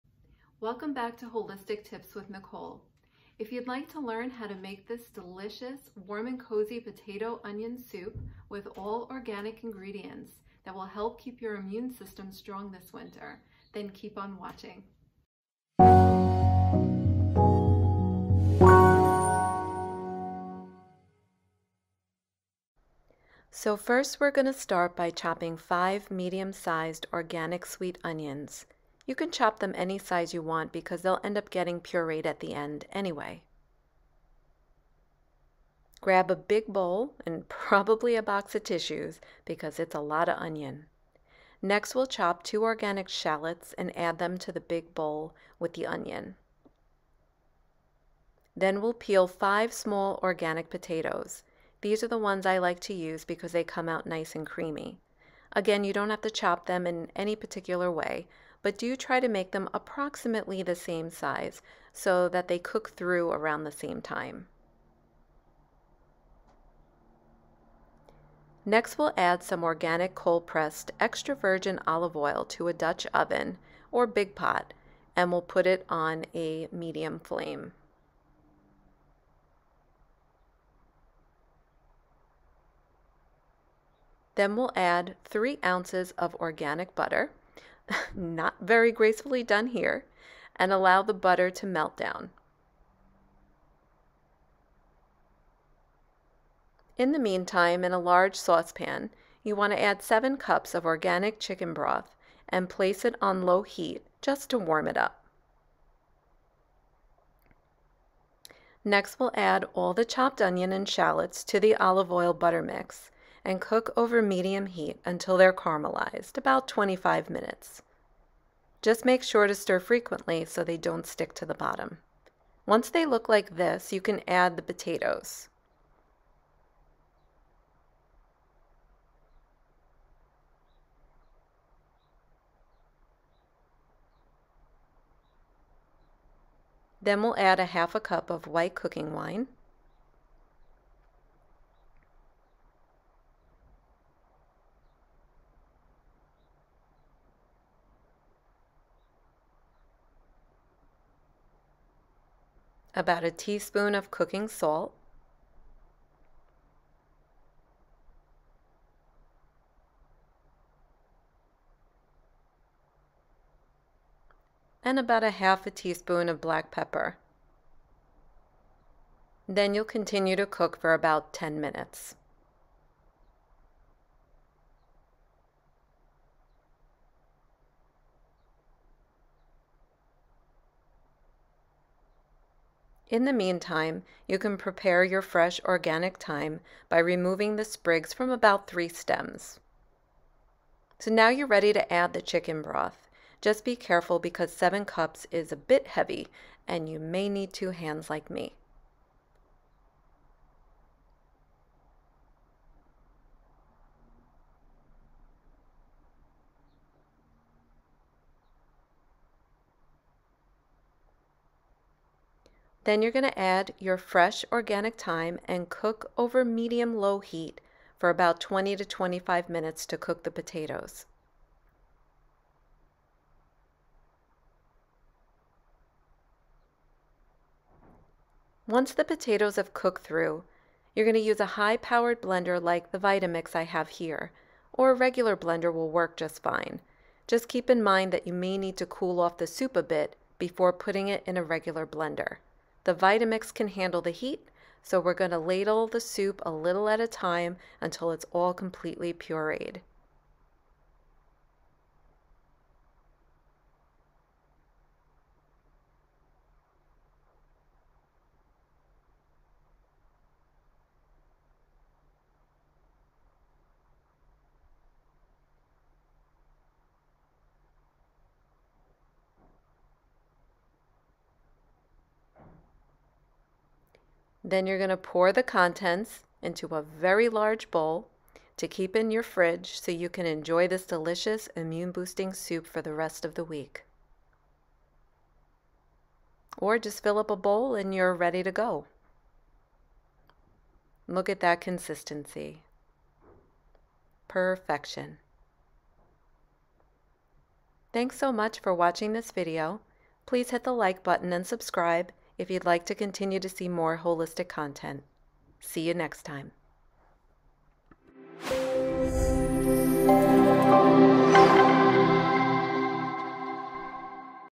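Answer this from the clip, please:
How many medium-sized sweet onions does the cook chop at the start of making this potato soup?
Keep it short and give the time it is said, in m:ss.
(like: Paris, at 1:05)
5, at 0:25.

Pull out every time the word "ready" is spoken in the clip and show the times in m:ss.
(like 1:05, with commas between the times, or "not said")
3:11, 4:48.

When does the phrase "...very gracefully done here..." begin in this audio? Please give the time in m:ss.
1:28.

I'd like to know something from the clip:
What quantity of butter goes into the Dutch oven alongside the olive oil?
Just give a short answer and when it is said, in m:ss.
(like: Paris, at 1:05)
3 ounces, at 1:25.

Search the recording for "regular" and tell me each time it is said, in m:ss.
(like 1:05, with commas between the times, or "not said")
3:54, 4:01.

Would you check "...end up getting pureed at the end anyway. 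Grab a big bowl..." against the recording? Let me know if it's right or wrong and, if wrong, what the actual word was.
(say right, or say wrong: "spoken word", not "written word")
right.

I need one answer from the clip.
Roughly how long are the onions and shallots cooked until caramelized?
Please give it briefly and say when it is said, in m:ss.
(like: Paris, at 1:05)
25 minutes, at 1:56.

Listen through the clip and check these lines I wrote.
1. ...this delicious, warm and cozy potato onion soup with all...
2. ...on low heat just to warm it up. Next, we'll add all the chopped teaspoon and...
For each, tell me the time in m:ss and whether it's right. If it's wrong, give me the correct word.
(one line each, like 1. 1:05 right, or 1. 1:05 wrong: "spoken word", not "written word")
1. 0:04 right
2. 1:43 wrong: "onion", not "teaspoon".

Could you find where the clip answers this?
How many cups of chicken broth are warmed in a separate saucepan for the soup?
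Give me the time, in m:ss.
1:40.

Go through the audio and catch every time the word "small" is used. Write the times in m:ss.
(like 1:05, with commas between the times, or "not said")
0:49.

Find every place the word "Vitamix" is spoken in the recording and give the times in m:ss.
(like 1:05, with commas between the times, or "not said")
3:52, 4:02.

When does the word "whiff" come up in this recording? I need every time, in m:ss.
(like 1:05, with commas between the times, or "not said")
not said.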